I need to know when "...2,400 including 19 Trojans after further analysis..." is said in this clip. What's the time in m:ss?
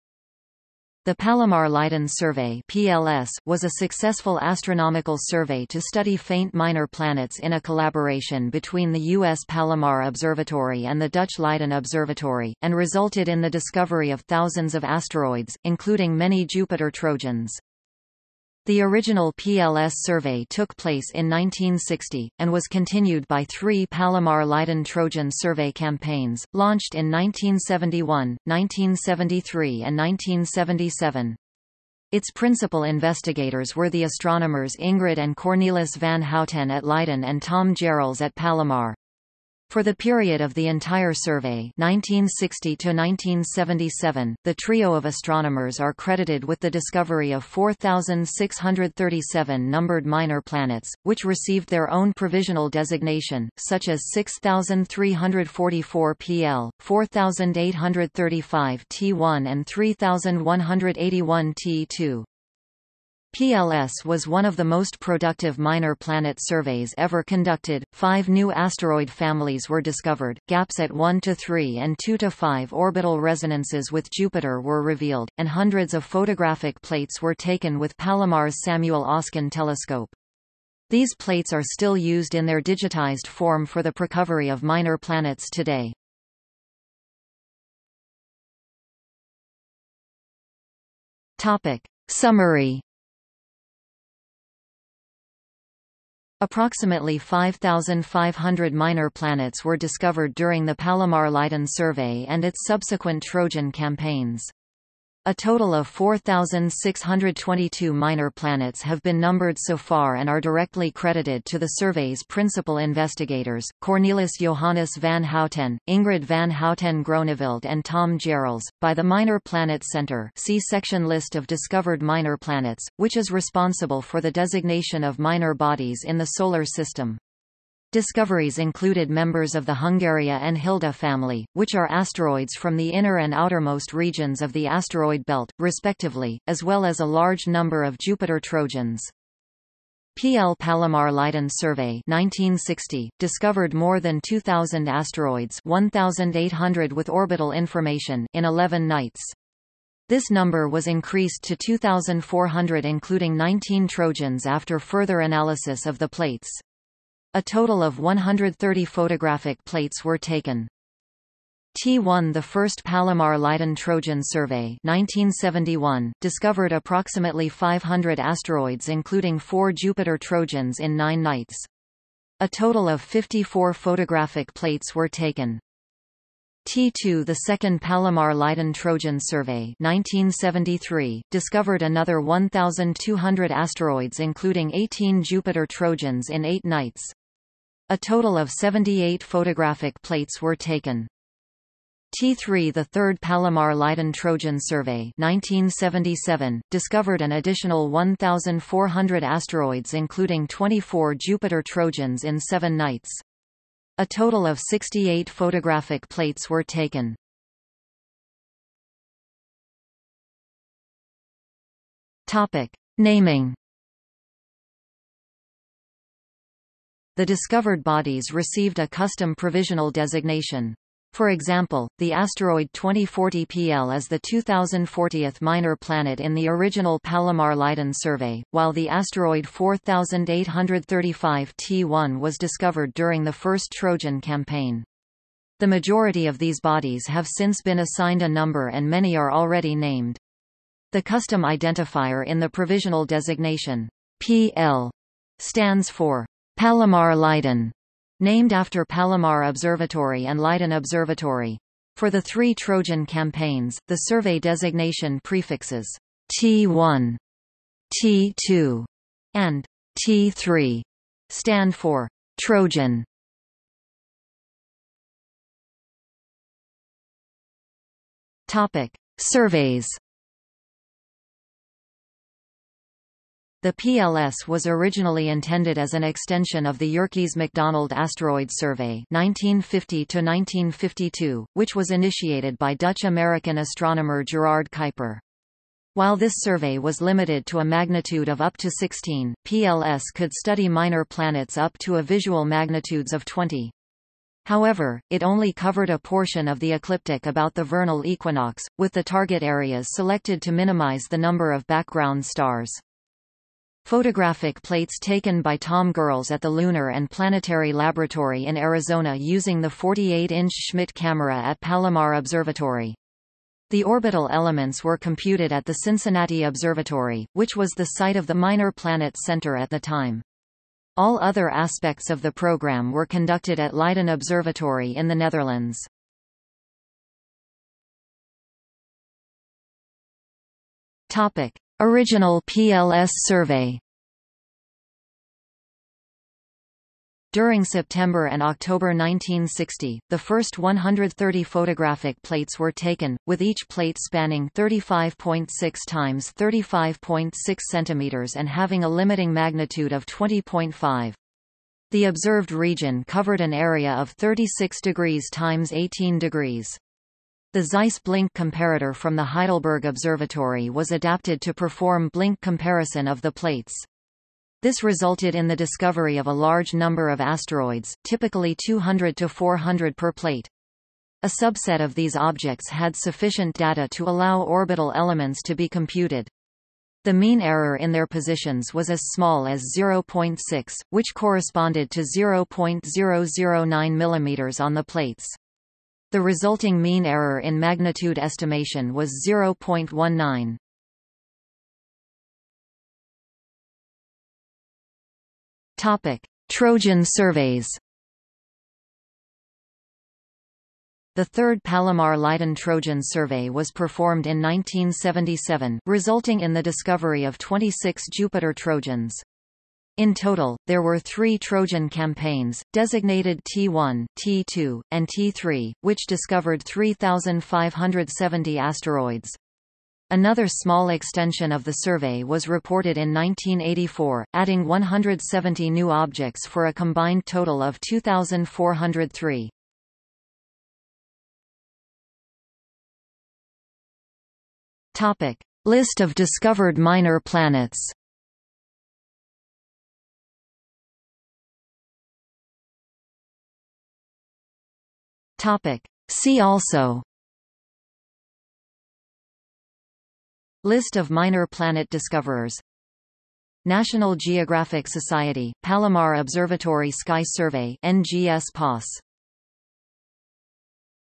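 2:31.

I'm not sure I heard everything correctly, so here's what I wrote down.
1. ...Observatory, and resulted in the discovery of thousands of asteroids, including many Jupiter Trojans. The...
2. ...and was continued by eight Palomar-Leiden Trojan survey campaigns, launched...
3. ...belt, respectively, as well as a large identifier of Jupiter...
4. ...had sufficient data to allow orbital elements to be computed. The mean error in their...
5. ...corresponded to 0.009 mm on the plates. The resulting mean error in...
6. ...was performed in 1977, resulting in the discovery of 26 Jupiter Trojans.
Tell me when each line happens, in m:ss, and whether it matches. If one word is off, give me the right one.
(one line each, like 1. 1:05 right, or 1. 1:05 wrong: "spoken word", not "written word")
1. 0:11 right
2. 0:22 wrong: "three", not "eight"
3. 2:15 wrong: "number", not "identifier"
4. 6:12 right
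5. 6:21 right
6. 6:43 right.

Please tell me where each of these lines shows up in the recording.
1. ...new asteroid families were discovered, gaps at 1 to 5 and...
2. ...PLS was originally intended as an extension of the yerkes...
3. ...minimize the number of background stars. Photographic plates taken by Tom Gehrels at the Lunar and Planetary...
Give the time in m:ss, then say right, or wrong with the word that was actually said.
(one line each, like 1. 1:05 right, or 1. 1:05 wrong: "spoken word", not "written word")
1. 1:08 wrong: "3", not "5"
2. 4:33 right
3. 5:00 right.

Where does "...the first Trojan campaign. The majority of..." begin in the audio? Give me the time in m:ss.
3:53.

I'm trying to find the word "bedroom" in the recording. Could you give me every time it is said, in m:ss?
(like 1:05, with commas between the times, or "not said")
not said.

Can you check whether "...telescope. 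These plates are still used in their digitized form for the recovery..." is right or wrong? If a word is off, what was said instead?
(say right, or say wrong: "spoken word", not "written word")
right.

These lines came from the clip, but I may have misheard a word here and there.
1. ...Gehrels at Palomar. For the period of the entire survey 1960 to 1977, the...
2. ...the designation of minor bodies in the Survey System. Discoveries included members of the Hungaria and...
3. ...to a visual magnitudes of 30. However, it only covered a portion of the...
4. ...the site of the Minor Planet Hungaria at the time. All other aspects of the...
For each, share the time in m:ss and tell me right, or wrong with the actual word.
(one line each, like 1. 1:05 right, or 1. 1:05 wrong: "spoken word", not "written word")
1. 0:37 right
2. 2:04 wrong: "Solar", not "Survey"
3. 4:51 wrong: "20", not "30"
4. 5:17 wrong: "Center", not "Hungaria".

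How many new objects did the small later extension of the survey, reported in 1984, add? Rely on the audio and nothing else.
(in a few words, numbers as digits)
170.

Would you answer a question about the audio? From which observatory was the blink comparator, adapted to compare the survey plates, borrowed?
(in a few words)
Heidelberg Observatory.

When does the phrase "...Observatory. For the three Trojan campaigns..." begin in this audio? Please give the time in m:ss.
4:10.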